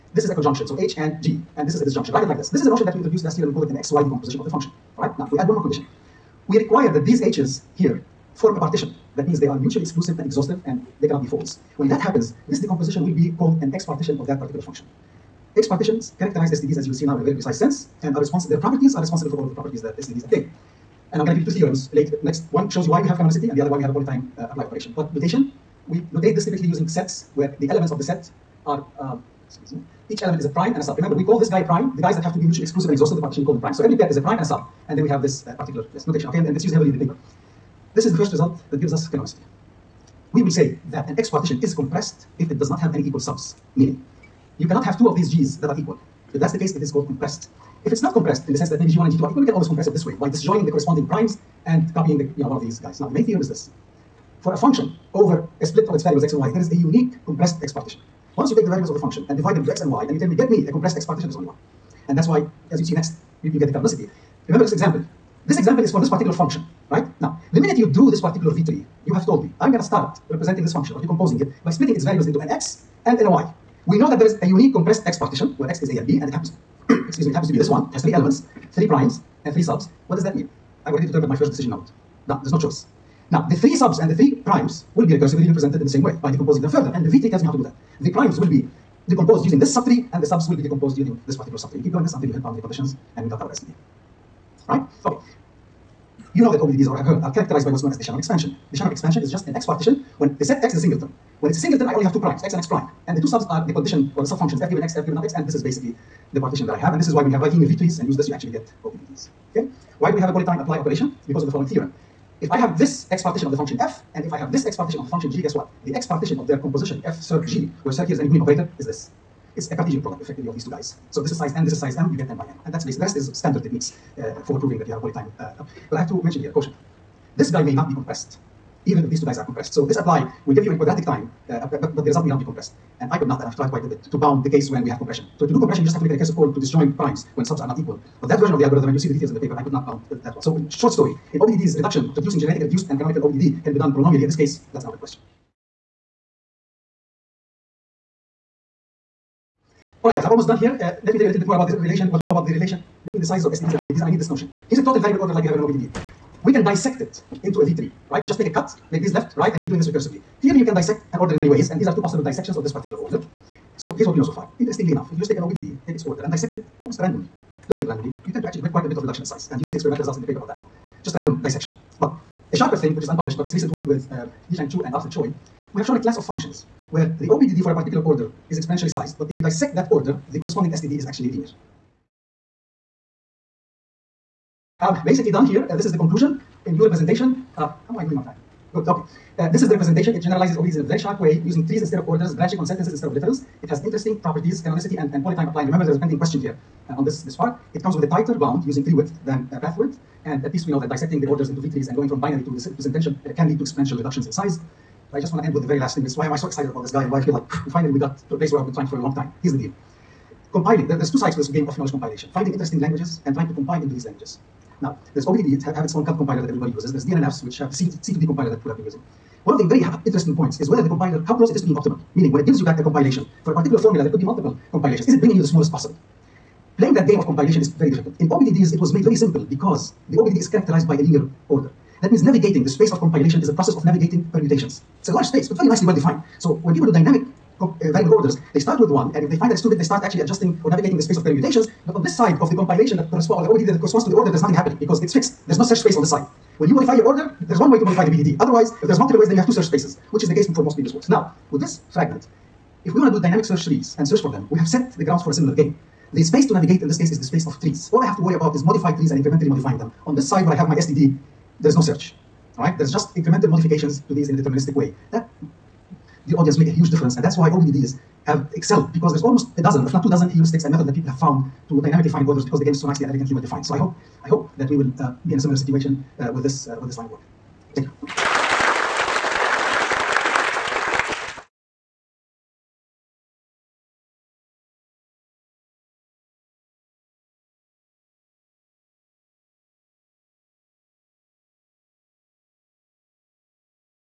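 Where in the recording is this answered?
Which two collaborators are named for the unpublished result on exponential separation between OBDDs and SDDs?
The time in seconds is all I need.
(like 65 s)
174 s.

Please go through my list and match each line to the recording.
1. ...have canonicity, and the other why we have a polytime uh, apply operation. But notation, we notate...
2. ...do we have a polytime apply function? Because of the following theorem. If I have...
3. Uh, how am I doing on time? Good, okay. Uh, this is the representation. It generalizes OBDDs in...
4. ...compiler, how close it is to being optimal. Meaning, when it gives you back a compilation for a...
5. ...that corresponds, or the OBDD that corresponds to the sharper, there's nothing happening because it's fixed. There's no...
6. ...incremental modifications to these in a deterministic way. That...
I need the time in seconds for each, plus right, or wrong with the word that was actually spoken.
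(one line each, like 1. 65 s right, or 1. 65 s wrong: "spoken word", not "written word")
1. 23 s right
2. 110 s wrong: "operation", not "function"
3. 187 s right
4. 220 s right
5. 242 s wrong: "order", not "sharper"
6. 263 s right.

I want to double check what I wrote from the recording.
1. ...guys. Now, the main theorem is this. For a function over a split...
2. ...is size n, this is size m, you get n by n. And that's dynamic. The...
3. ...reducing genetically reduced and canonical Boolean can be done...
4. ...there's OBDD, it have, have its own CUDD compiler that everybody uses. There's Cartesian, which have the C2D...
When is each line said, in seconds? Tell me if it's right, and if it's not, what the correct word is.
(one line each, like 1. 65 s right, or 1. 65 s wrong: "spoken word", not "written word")
1. 52 s right
2. 121 s wrong: "basic", not "dynamic"
3. 142 s wrong: "OBDD", not "Boolean"
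4. 215 s wrong: "DNNFs", not "Cartesian".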